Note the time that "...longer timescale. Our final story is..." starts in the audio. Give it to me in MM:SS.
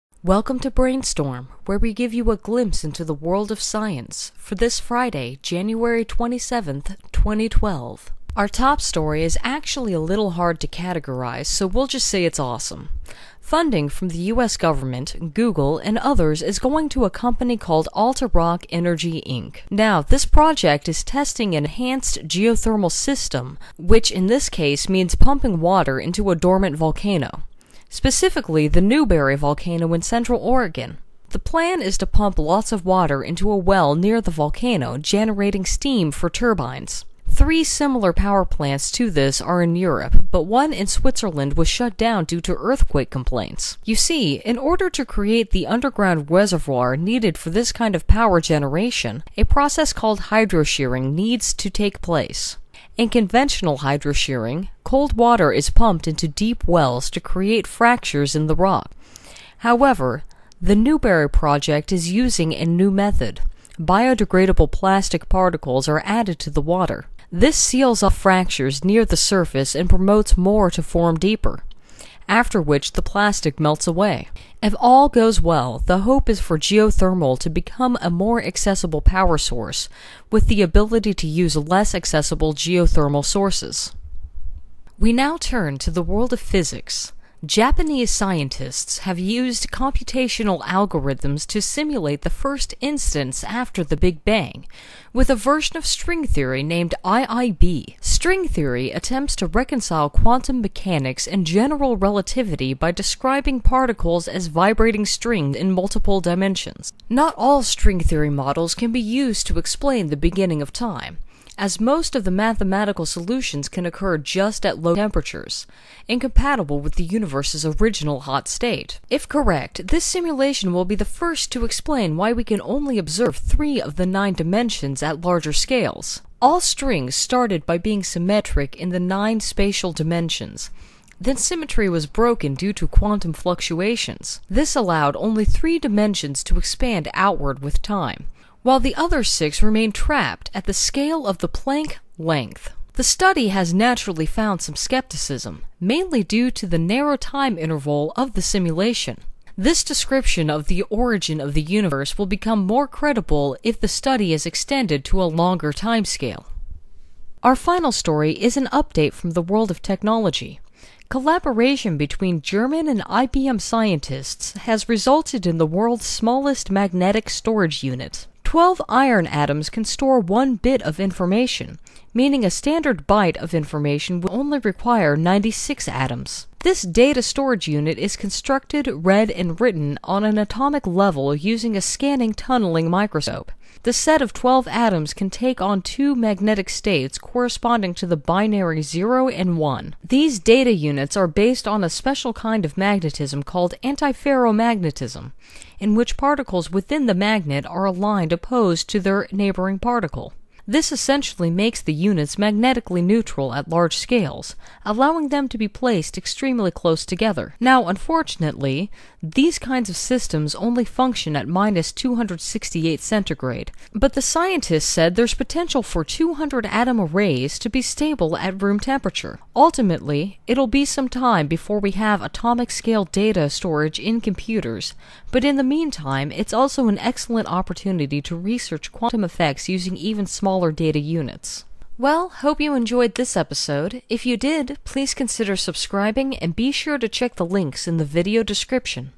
02:35.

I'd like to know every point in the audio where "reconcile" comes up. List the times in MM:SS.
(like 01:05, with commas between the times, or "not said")
01:39.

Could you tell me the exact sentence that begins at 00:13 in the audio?
Funding from the US government, Google, and others is going to a company called AltaRock Energy Inc.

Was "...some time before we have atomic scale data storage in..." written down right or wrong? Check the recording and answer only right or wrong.
right.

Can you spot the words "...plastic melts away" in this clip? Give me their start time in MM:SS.
01:13.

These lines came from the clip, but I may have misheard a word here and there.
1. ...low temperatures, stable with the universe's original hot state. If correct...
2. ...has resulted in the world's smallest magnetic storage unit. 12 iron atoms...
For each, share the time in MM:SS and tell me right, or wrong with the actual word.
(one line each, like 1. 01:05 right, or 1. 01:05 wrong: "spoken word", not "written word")
1. 01:54 wrong: "incompatible", not "stable"
2. 02:44 right.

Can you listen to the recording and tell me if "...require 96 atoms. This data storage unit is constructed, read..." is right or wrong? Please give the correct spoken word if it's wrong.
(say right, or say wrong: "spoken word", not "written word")
right.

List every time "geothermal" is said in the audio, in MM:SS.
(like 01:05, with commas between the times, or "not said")
00:22, 01:16, 01:22.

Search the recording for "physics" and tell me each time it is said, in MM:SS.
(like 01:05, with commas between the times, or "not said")
01:26.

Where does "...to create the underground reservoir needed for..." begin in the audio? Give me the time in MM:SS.
00:44.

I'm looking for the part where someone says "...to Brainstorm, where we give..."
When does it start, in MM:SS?
00:00.